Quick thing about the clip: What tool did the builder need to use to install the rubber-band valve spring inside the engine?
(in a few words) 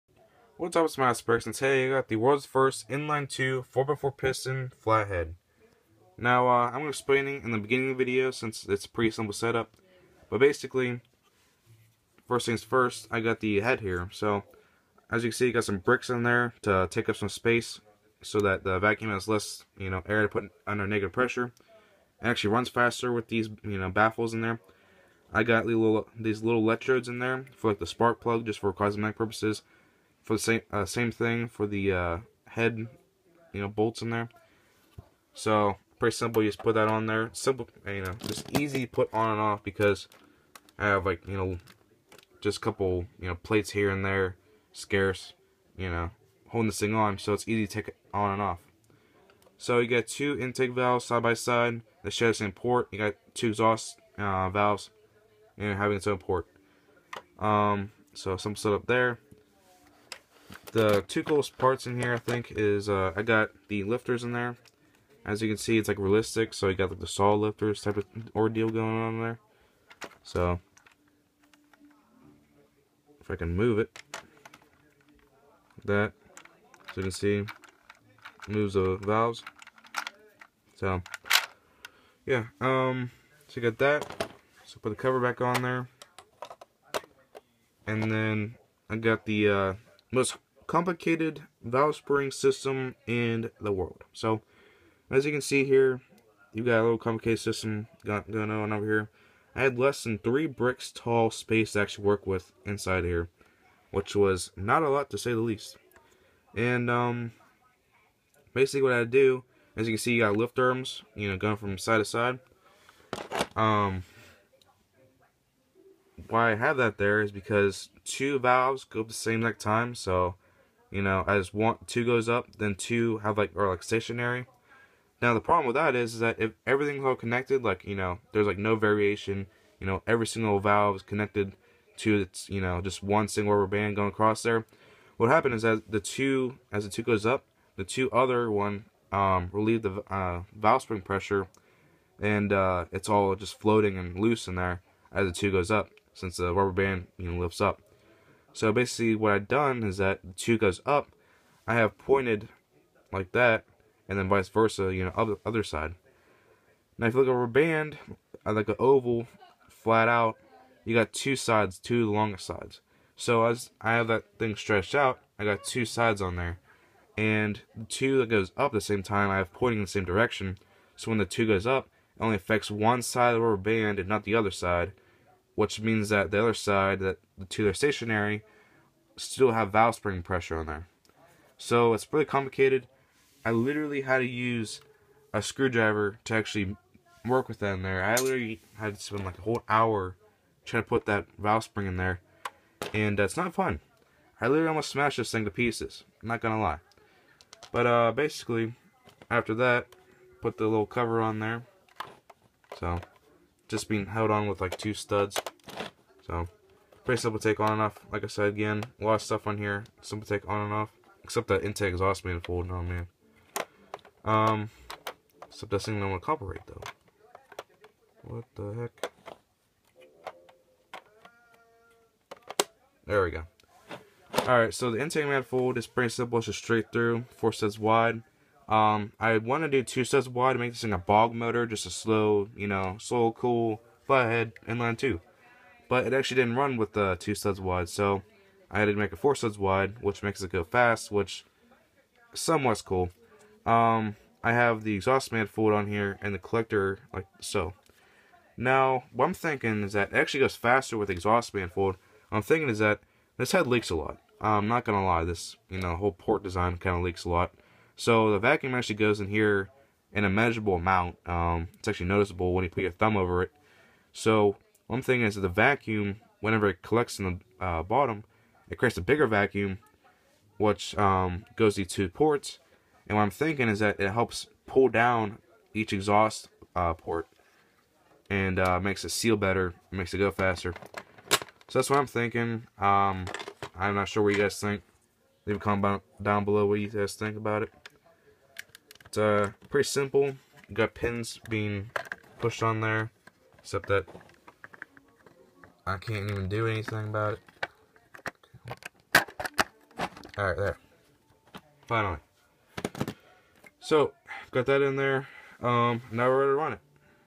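screwdriver.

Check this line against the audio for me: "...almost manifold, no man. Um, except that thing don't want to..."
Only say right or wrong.
wrong.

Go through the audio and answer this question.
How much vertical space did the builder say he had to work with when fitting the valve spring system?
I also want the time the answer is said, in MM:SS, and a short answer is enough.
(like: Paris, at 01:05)
less than 3 bricks tall, at 01:39.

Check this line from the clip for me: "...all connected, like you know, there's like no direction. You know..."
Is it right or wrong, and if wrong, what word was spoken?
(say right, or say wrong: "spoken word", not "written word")
wrong: "variation", not "direction".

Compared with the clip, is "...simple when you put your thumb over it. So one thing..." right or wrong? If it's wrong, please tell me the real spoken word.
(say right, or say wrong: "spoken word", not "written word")
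wrong: "noticeable", not "simple".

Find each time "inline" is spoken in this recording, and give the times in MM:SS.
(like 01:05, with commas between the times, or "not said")
00:02, 03:54.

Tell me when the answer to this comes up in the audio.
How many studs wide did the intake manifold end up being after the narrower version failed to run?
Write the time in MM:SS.
03:59.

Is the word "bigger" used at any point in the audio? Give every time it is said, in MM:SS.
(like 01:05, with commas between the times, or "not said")
04:29.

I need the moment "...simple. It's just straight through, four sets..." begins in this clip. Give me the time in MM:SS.
03:46.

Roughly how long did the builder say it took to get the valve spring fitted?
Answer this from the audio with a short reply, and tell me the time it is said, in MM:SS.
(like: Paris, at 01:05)
a whole hour, at 03:09.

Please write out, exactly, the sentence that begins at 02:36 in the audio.
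Now if you look over a band, like an oval, flat out, you got two sides, two longer sides.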